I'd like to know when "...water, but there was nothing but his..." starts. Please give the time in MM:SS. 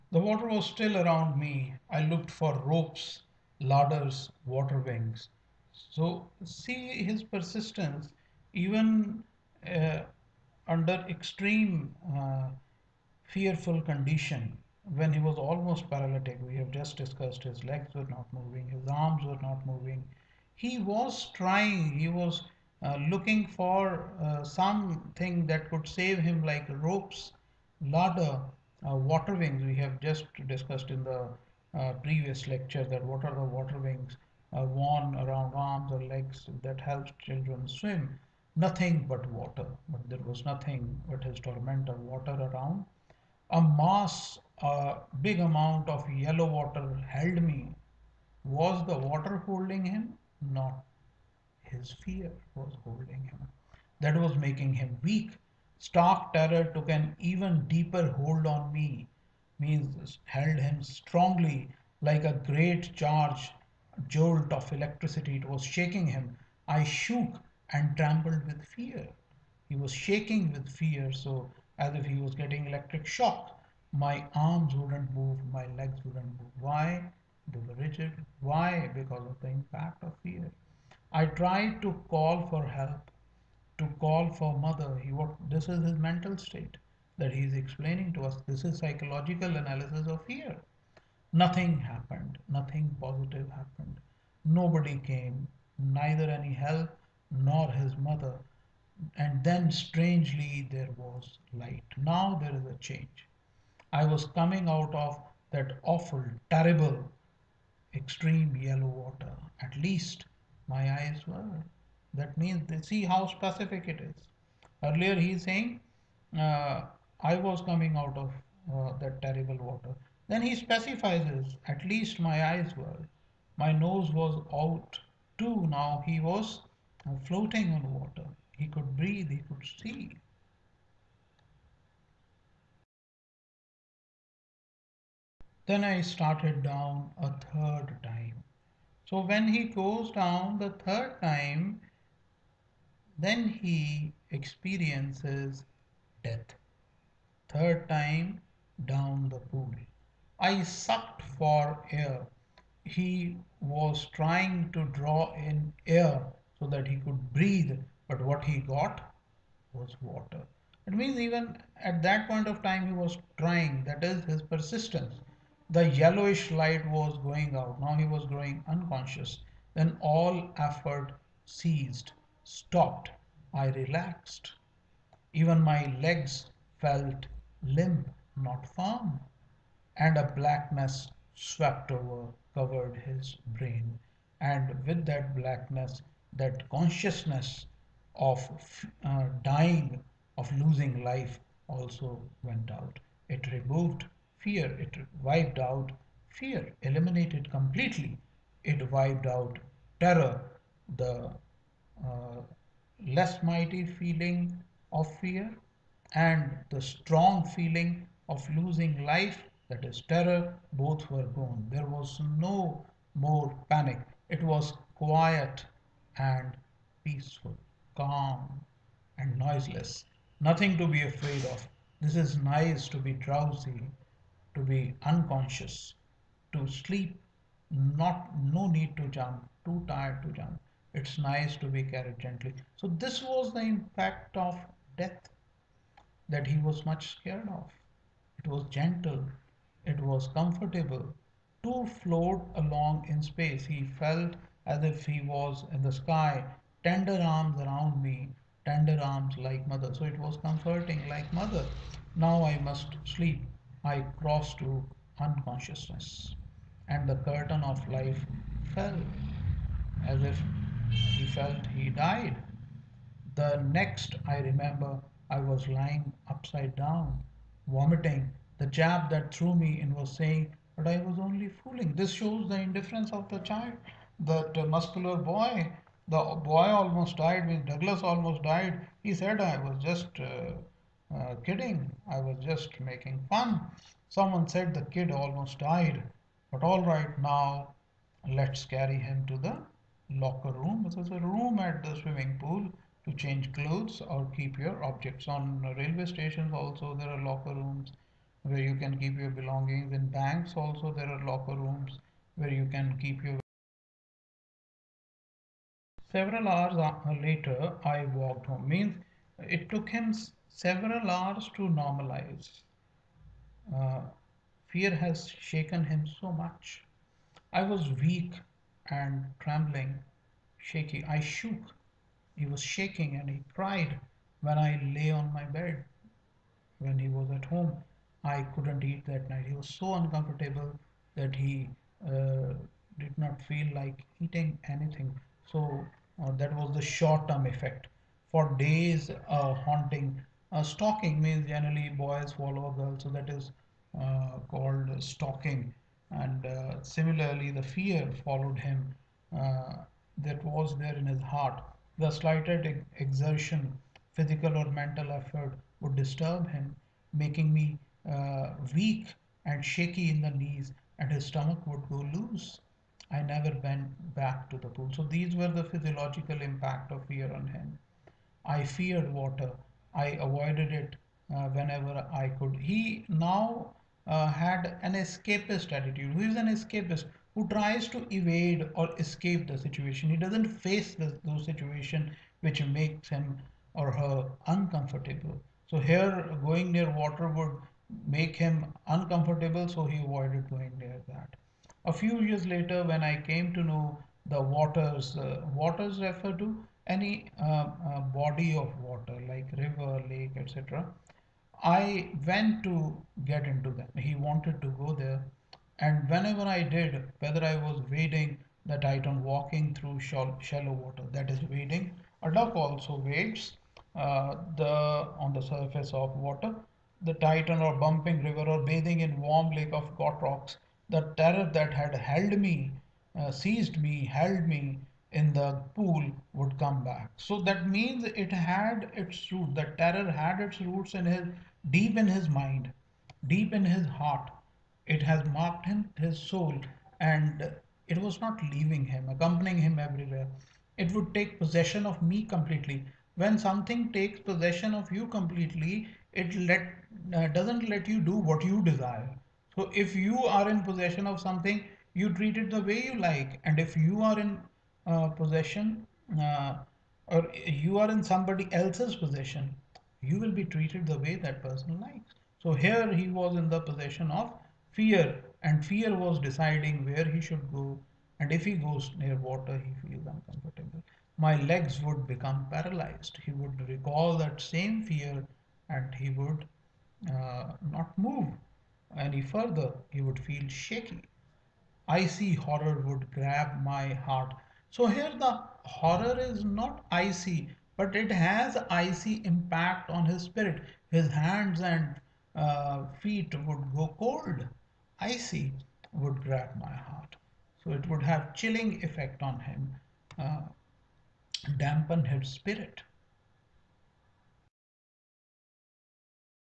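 00:39.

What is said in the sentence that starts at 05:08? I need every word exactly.
Means it took him several hours to normalize.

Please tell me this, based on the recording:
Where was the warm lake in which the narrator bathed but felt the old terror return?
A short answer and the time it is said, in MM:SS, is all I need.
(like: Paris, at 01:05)
Goat Rocks, at 06:59.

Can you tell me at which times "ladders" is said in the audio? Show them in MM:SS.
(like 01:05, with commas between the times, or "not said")
00:03, 00:27.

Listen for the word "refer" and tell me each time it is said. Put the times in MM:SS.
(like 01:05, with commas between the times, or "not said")
06:36.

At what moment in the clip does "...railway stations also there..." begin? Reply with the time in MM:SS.
04:55.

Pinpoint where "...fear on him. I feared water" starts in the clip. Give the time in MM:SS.
06:07.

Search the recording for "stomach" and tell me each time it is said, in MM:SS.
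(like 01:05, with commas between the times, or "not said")
06:01.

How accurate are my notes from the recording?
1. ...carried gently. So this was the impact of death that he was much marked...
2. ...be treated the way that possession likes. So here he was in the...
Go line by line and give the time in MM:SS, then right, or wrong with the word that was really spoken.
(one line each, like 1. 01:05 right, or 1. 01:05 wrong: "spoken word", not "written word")
1. 03:51 wrong: "scared", not "marked"
2. 07:40 wrong: "person", not "possession".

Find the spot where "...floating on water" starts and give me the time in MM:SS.
02:07.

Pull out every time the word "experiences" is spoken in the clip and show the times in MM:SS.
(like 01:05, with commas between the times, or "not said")
02:24.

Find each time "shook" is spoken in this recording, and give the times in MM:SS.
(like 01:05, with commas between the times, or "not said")
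01:06, 05:21.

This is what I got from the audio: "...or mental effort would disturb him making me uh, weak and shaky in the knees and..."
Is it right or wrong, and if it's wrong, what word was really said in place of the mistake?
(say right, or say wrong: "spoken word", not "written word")
right.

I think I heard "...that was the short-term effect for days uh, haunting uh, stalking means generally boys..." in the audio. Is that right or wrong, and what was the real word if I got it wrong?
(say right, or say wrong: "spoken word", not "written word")
right.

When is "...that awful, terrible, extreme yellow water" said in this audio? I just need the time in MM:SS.
01:45.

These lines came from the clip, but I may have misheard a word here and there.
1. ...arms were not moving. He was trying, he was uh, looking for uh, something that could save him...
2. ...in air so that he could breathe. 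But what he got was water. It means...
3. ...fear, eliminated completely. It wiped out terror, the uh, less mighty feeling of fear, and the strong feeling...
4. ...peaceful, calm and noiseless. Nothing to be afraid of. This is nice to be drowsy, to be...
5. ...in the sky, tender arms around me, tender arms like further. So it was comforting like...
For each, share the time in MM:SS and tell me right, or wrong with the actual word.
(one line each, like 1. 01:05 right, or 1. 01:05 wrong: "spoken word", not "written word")
1. 00:18 right
2. 02:35 right
3. 03:16 right
4. 03:37 right
5. 04:05 wrong: "mother", not "further".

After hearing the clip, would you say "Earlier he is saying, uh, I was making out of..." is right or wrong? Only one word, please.
wrong.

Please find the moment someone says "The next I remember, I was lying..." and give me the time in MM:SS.
04:23.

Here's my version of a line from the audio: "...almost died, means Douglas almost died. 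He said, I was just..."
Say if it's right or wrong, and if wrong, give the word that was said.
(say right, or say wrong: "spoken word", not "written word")
right.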